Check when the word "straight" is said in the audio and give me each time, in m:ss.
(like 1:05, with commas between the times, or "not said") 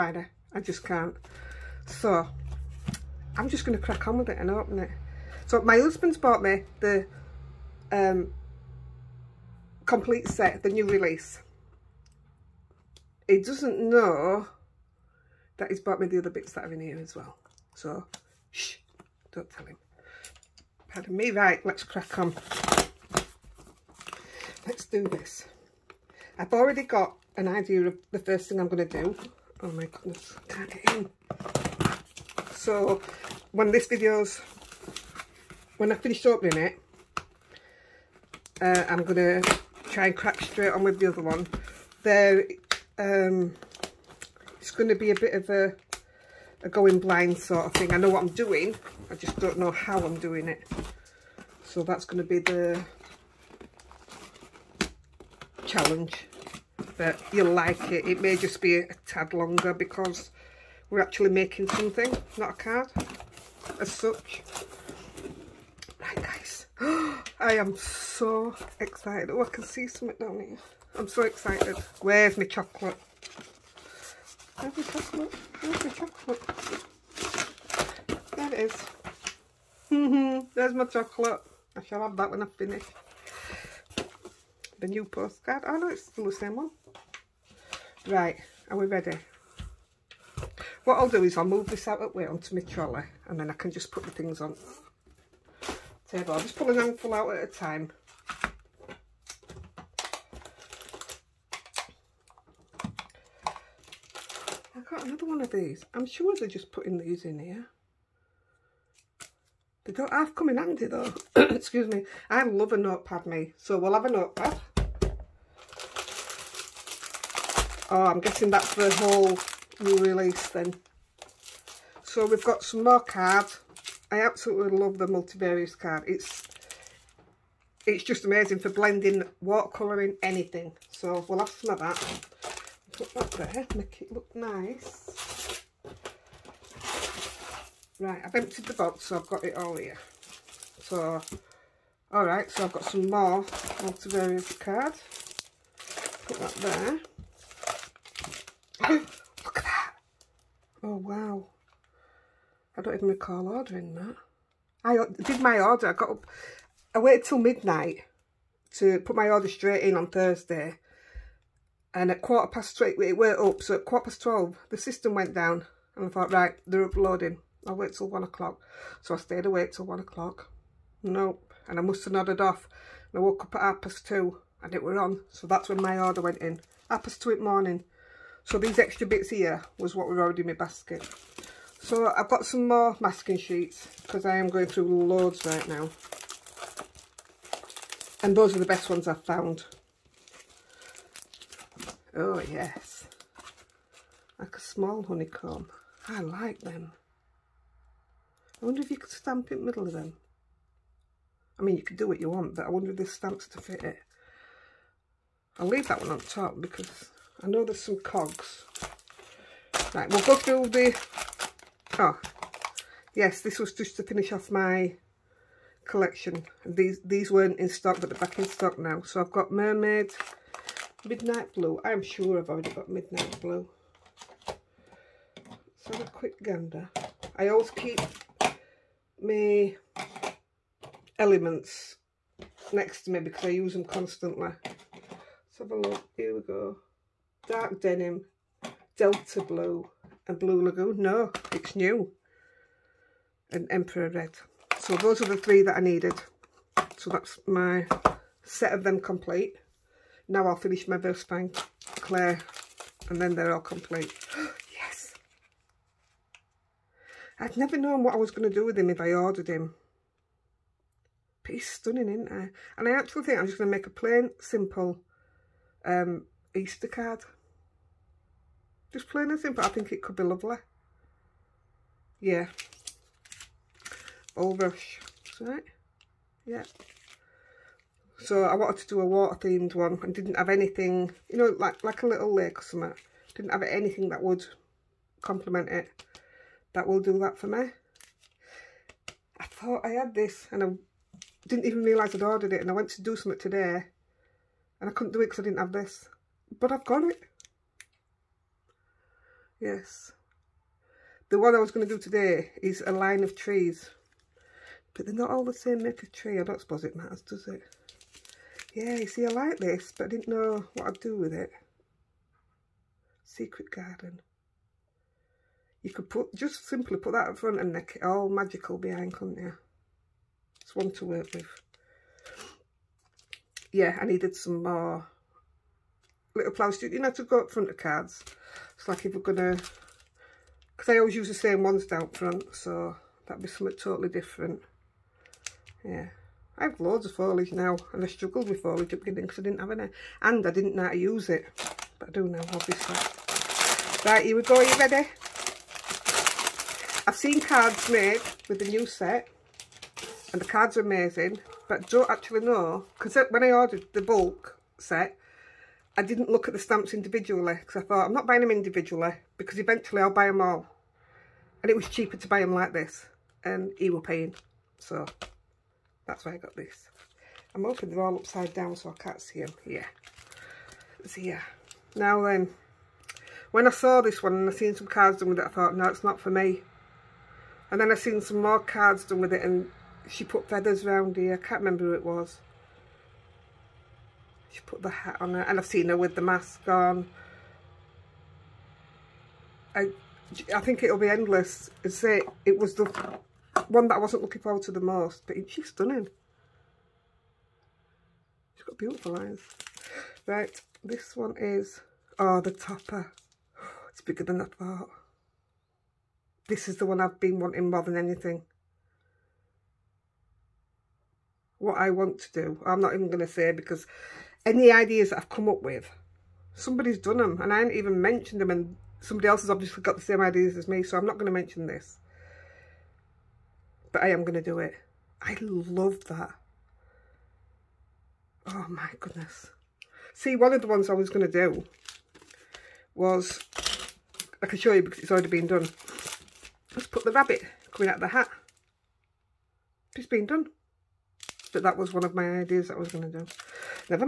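0:40, 2:39.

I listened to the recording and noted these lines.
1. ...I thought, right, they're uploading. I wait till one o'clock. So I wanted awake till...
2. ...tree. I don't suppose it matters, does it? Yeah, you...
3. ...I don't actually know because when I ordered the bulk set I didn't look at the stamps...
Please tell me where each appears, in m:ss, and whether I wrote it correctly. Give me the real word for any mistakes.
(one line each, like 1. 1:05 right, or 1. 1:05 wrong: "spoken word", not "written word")
1. 2:46 wrong: "stayed", not "wanted"
2. 5:06 right
3. 5:51 right.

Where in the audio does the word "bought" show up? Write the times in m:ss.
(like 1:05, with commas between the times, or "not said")
0:06, 0:15.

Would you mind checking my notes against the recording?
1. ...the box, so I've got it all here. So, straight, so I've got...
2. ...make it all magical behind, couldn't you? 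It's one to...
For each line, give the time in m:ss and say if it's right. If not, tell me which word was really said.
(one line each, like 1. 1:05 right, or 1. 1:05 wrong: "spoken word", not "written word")
1. 2:18 wrong: "alright", not "straight"
2. 5:17 right.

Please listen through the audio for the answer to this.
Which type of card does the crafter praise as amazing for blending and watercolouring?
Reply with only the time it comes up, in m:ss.
2:05.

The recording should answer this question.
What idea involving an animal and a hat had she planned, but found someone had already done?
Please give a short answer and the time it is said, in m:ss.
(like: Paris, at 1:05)
Rabbit coming out of the hat, at 7:17.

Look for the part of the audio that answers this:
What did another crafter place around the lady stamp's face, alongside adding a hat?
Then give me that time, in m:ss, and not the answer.
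6:20.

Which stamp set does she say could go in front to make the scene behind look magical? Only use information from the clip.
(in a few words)
Secret Garden.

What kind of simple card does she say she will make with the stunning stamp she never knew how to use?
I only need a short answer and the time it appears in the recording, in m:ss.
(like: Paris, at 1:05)
Easter card, at 4:26.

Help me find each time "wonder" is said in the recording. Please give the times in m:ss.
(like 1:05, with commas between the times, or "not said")
3:18, 3:22.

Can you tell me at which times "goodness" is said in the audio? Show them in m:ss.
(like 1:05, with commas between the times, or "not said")
0:29, 7:08.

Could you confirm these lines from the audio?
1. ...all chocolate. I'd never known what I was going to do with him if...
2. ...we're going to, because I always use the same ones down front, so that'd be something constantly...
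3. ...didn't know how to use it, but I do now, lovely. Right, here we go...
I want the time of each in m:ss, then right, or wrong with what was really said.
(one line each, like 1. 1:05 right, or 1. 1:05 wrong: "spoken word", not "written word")
1. 4:13 wrong: "complete", not "chocolate"
2. 5:29 wrong: "totally", not "constantly"
3. 5:40 wrong: "obviously", not "lovely".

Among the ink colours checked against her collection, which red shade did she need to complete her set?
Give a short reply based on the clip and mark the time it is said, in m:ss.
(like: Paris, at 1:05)
Emperor Red, at 4:03.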